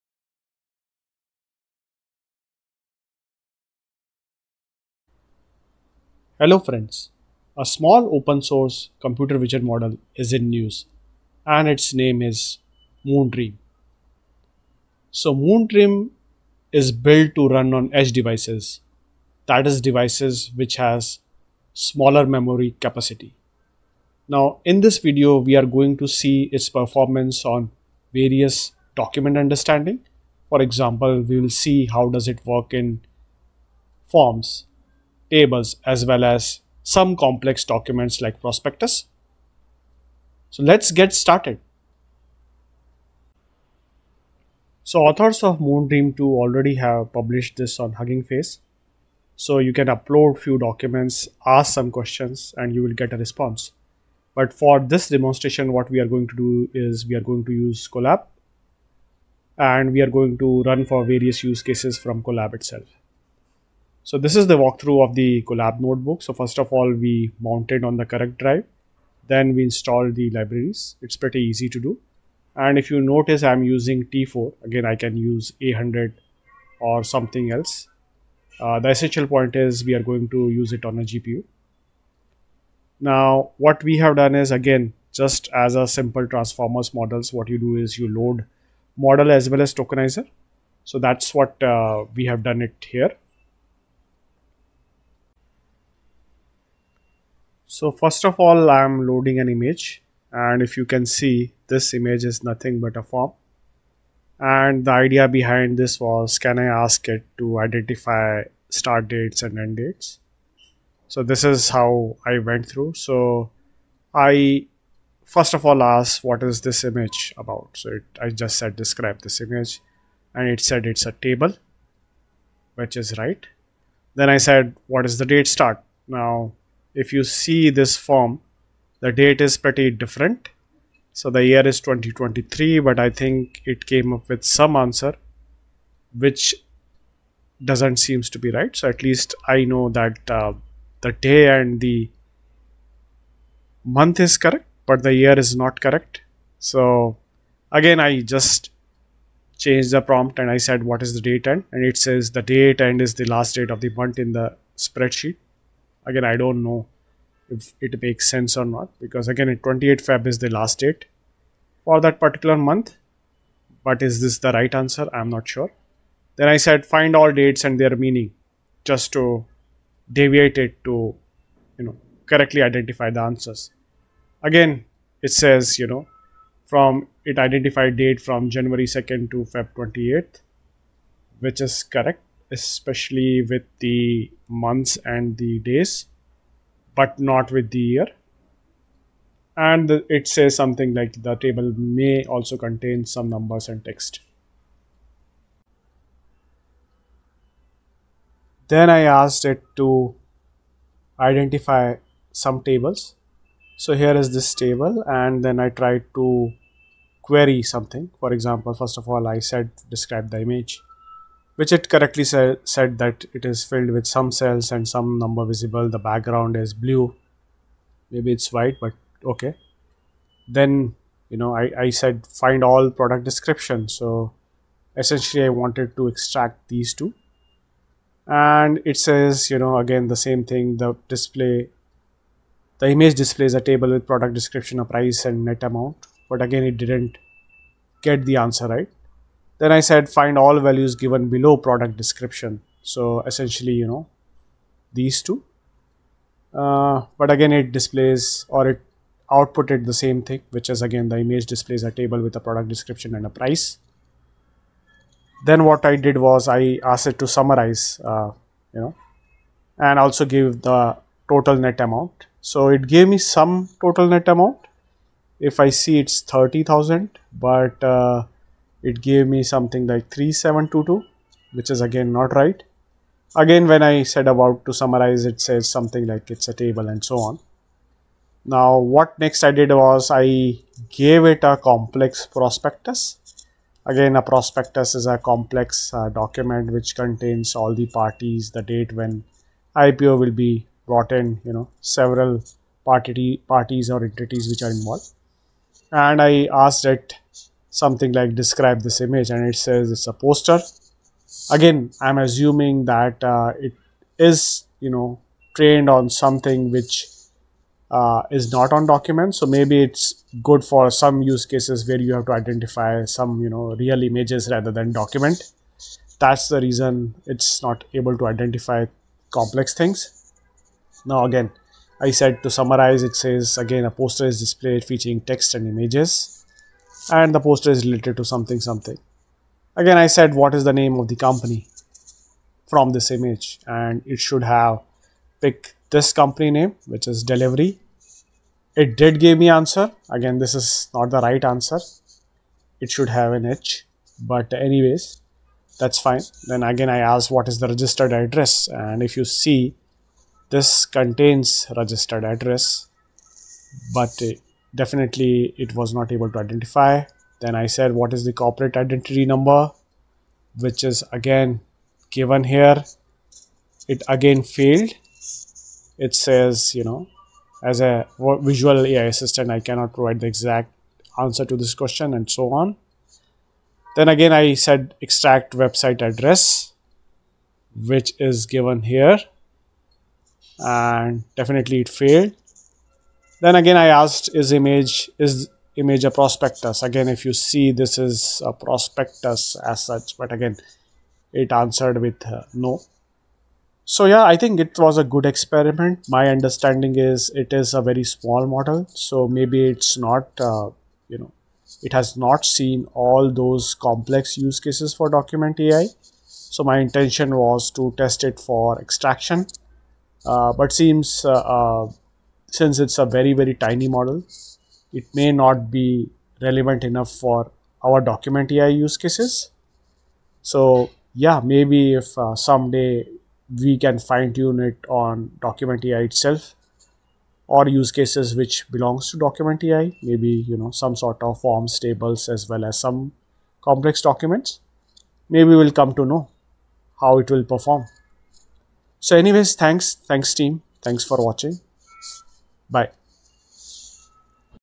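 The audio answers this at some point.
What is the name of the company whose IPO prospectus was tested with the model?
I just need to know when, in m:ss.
5:37.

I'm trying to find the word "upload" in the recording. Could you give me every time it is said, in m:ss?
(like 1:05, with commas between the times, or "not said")
0:49.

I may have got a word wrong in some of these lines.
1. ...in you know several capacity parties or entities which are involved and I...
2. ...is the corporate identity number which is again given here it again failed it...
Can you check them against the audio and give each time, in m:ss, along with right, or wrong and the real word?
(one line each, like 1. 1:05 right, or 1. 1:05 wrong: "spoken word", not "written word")
1. 4:51 wrong: "party", not "capacity"
2. 5:58 right.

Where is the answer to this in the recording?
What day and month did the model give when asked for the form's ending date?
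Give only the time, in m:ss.
2:39.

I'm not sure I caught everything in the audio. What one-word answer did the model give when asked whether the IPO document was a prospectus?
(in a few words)
No.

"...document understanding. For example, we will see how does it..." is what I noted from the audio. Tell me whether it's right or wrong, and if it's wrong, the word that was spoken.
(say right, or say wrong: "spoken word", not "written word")
right.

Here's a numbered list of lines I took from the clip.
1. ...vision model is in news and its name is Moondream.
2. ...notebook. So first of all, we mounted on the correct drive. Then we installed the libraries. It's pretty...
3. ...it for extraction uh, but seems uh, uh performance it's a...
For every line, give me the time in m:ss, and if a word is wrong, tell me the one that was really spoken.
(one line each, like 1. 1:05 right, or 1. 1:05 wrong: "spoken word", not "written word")
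1. 0:09 right
2. 1:05 right
3. 6:48 wrong: "since", not "performance".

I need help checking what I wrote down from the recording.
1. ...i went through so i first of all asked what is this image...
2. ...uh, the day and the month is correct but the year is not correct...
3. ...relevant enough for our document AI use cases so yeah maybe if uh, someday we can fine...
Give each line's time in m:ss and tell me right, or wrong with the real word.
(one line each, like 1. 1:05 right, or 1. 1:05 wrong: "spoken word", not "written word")
1. 1:52 right
2. 2:20 right
3. 6:56 right.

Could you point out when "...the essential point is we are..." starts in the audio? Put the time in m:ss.
1:18.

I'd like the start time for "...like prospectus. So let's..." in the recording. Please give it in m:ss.
0:38.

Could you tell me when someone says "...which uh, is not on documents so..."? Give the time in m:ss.
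5:06.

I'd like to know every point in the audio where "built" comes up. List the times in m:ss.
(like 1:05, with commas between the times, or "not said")
0:16.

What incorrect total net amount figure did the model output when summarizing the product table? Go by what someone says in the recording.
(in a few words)
3722.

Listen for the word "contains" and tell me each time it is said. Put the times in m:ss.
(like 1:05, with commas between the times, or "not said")
3:12, 4:46, 5:50.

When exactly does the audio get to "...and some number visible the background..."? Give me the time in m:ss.
3:34.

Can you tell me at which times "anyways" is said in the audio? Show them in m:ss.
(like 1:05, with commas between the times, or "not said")
5:44, 7:19.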